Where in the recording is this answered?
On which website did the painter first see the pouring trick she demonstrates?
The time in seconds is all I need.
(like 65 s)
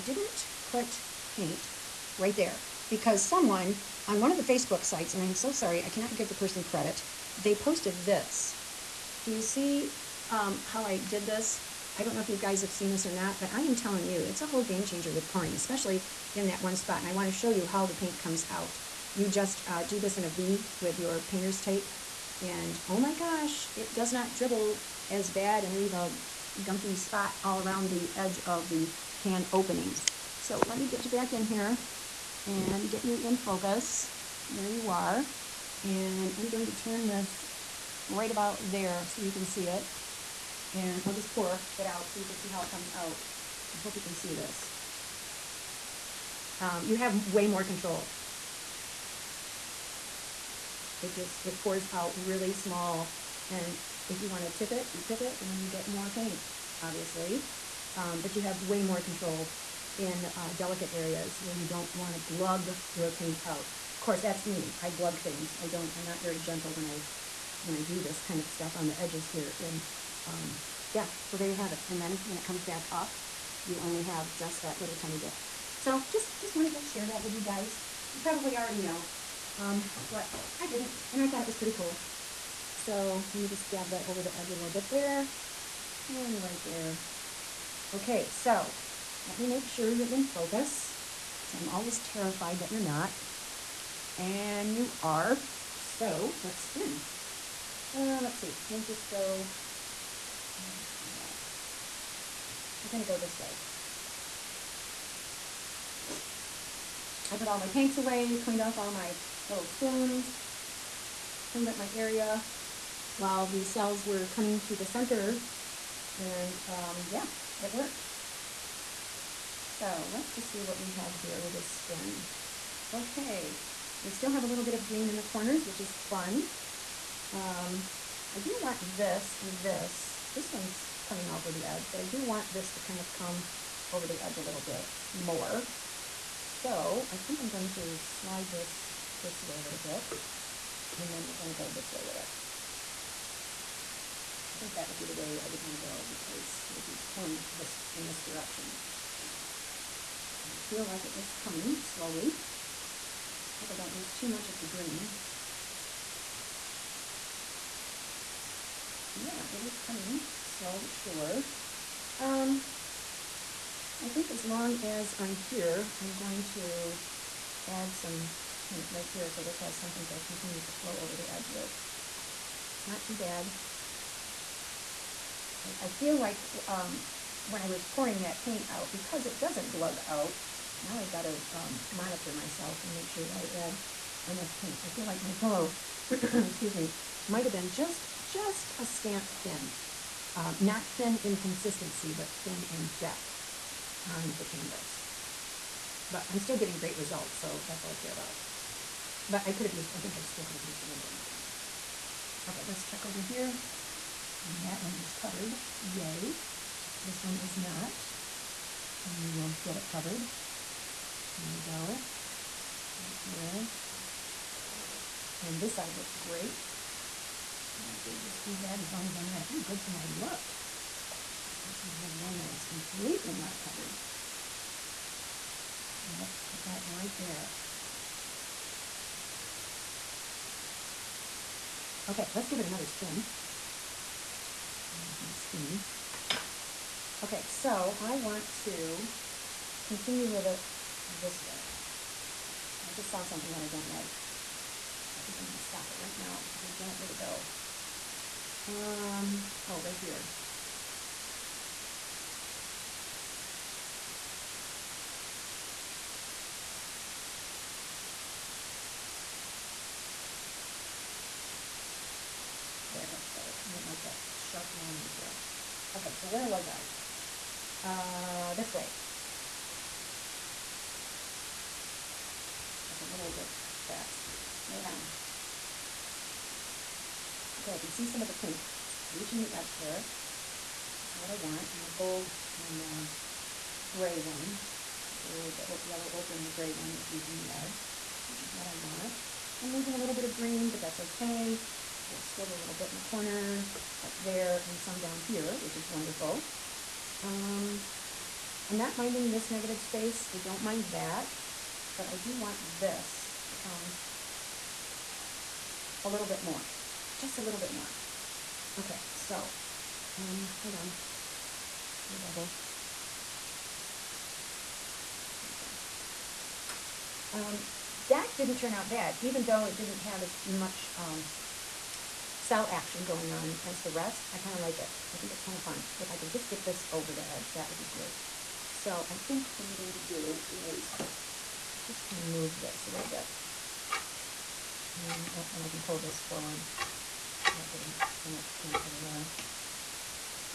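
4 s.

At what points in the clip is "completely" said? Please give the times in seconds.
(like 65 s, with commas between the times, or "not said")
222 s.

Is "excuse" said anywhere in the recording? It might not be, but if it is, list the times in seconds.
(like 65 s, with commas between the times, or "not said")
186 s.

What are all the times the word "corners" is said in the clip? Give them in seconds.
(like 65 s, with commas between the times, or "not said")
125 s, 293 s.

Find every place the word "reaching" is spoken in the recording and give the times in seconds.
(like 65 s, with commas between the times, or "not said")
279 s, 287 s.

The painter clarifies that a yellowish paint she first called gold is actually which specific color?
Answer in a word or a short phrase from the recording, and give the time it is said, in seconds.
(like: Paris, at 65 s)
Yellow ochre, at 285 s.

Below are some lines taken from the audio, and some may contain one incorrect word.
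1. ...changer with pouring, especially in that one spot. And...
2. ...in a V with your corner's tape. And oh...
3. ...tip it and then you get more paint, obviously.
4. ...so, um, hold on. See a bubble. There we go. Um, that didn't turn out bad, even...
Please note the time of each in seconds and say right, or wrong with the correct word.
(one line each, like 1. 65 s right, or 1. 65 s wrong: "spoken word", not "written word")
1. 14 s right
2. 20 s wrong: "painter", not "corner"
3. 55 s right
4. 309 s right.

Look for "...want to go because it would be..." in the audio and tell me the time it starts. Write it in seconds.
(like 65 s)
145 s.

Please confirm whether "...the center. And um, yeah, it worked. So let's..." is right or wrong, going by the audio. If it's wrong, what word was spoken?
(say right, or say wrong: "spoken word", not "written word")
right.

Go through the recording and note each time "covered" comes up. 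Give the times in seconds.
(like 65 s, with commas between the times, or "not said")
205 s, 209 s, 223 s.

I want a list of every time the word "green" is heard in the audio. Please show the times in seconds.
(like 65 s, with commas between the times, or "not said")
124 s, 154 s, 290 s.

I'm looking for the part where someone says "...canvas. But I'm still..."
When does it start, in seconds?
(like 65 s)
194 s.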